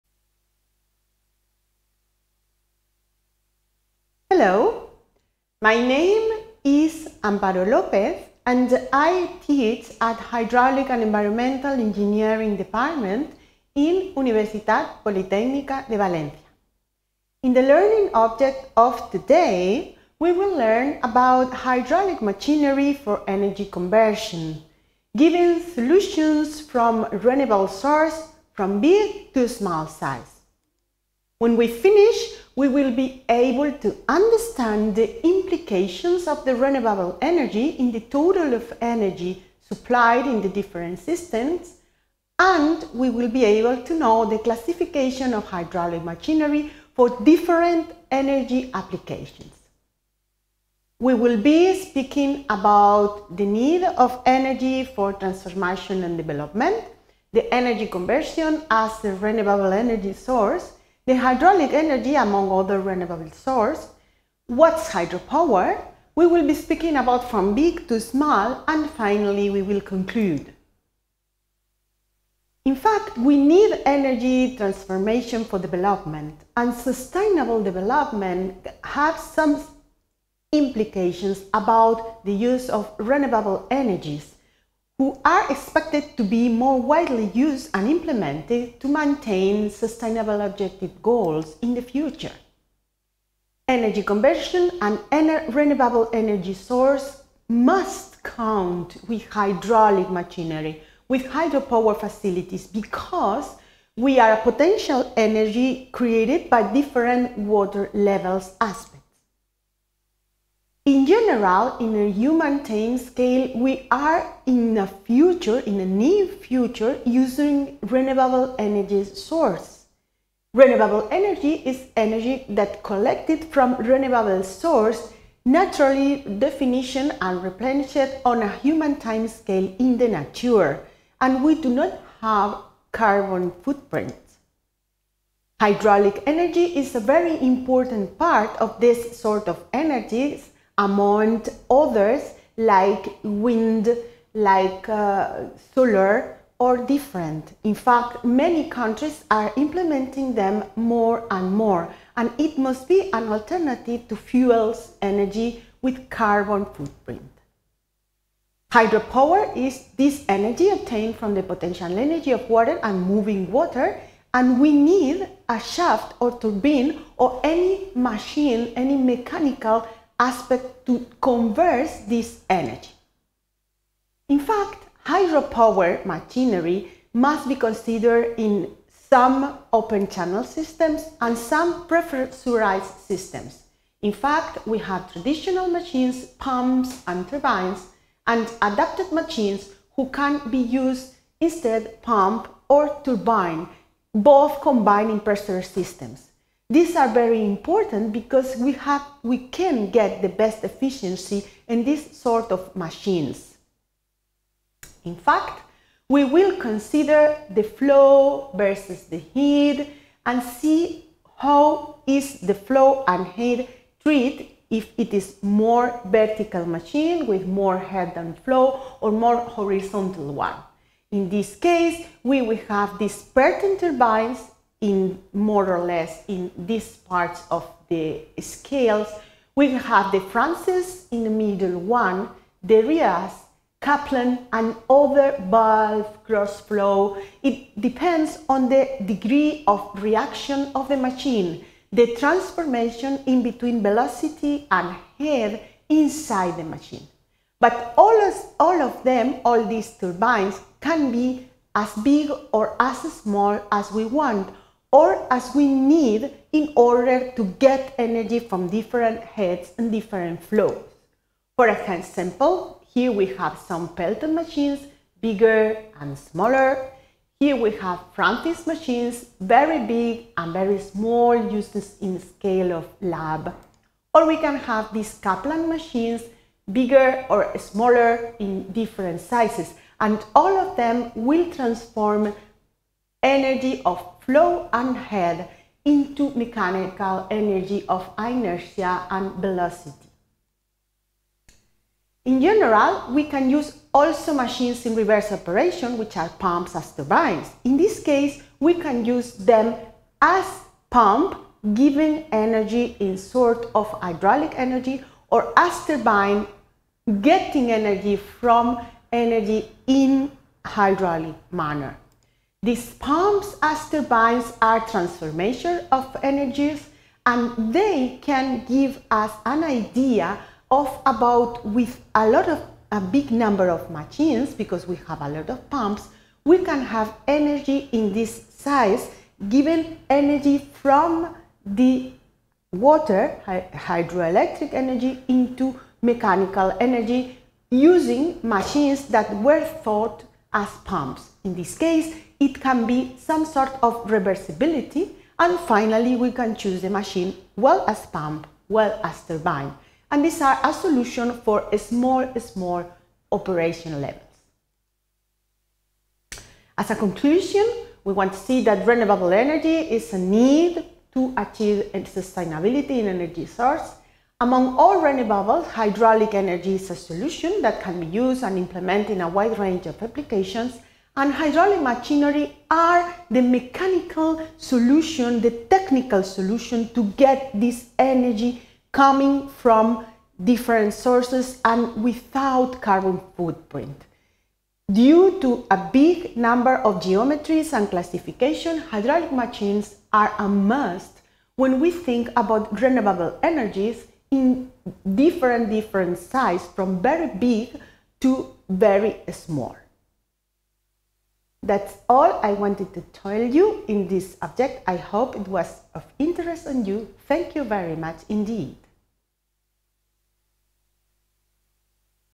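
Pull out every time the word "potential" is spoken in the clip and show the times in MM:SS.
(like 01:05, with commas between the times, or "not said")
01:44, 02:41.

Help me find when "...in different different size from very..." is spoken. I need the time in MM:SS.
06:34.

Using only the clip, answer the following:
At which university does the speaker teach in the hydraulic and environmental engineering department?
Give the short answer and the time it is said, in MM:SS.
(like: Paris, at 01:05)
Universitat Politècnica de Valencia, at 00:14.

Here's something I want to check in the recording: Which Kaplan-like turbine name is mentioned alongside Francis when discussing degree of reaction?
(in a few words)
Deriaz.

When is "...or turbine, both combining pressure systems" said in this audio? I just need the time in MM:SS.
03:12.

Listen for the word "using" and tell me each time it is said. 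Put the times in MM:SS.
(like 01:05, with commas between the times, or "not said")
01:57, 05:37.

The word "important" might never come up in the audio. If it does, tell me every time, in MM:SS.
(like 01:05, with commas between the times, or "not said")
02:17, 03:17.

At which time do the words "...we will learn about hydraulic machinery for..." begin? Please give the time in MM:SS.
00:20.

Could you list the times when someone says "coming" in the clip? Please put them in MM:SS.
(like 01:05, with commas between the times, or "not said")
06:18.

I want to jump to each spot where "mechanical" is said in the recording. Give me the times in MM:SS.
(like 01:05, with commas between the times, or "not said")
02:48, 04:46, 05:36, 06:13.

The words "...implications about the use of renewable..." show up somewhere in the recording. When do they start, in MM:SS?
01:20.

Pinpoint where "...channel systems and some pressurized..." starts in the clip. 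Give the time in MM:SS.
03:00.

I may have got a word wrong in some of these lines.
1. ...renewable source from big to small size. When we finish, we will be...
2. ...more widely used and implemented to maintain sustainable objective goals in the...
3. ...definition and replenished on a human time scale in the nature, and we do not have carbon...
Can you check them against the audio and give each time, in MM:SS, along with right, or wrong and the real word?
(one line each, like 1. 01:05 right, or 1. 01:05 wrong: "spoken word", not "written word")
1. 00:27 right
2. 01:26 right
3. 02:06 right.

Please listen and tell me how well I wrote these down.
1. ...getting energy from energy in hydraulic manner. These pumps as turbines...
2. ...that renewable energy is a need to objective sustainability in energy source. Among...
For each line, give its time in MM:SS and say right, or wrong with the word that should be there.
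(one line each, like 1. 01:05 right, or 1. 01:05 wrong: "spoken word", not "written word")
1. 05:07 right
2. 05:58 wrong: "achieve", not "objective".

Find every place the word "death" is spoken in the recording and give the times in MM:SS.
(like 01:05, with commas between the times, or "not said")
not said.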